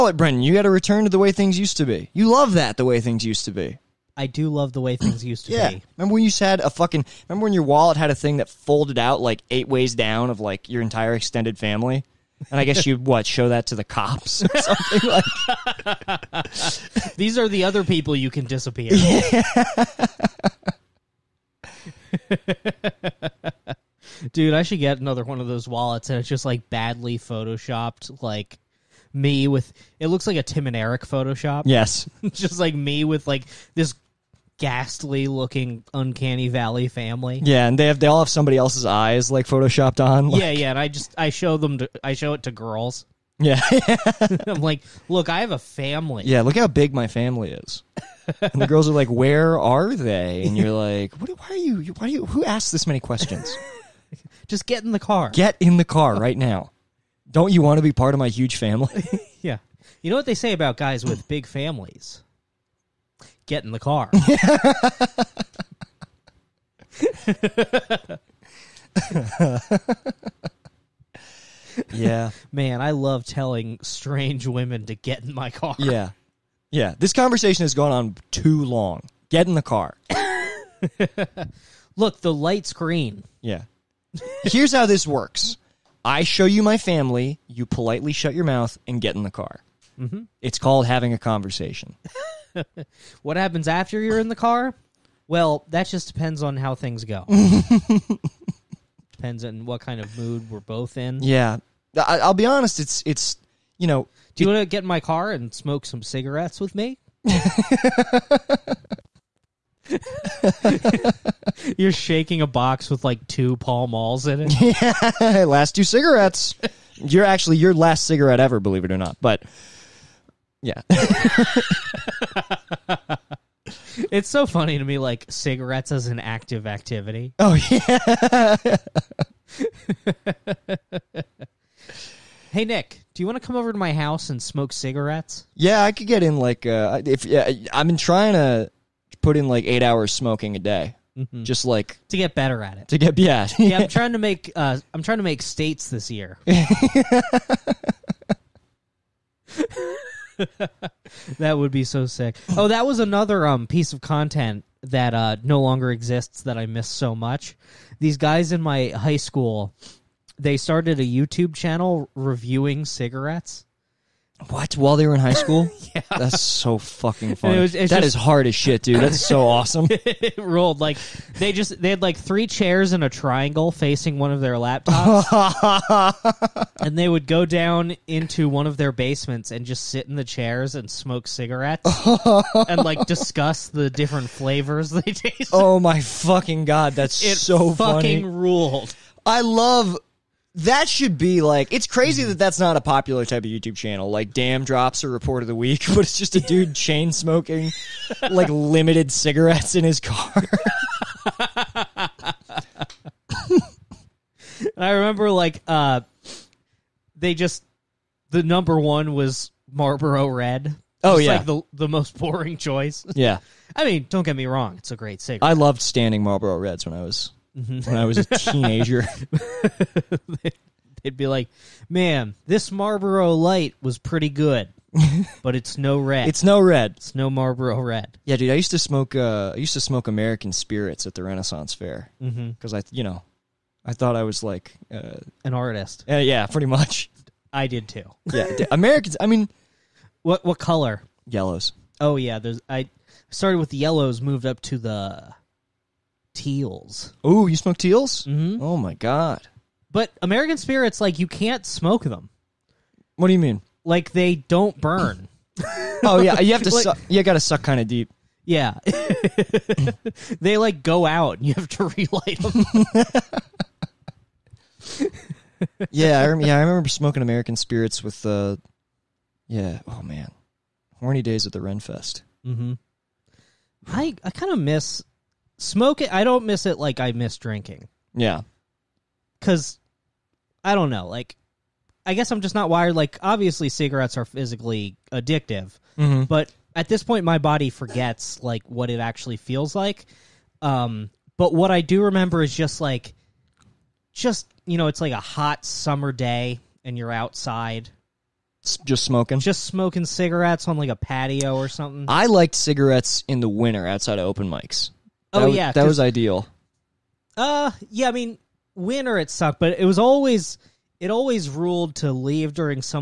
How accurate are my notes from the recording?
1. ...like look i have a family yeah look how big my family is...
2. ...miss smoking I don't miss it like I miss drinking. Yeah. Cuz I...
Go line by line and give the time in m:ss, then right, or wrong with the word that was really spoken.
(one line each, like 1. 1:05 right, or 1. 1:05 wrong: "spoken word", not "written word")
1. 0:44 right
2. 4:34 right.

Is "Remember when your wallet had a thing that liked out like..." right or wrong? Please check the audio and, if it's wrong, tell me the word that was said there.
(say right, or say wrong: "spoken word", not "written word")
wrong: "folded", not "liked".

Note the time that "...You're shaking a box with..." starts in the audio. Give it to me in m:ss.
1:51.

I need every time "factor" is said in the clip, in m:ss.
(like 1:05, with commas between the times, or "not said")
not said.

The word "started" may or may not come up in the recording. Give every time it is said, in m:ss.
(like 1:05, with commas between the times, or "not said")
2:40, 4:03.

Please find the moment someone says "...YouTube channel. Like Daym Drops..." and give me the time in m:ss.
3:13.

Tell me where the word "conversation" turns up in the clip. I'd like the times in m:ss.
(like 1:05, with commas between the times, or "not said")
1:17, 1:31.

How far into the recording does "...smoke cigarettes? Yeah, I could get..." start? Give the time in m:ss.
2:14.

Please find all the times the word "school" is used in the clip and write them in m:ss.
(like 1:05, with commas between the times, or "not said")
2:39, 2:45.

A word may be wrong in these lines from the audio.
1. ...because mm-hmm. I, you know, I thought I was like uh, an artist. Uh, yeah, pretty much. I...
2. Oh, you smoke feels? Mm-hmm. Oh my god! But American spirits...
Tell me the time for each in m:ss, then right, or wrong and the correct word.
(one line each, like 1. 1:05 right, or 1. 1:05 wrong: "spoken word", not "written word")
1. 3:52 right
2. 4:07 wrong: "teals", not "feels".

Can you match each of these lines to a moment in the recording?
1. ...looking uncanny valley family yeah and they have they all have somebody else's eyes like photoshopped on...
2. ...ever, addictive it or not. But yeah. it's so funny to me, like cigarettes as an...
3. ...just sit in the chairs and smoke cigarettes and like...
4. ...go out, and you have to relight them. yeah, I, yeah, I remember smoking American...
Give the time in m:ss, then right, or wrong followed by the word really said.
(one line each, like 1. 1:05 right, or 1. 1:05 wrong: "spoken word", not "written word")
1. 0:35 right
2. 1:58 wrong: "believe", not "addictive"
3. 2:59 right
4. 4:20 right.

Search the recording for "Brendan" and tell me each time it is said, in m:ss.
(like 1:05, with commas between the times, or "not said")
0:00.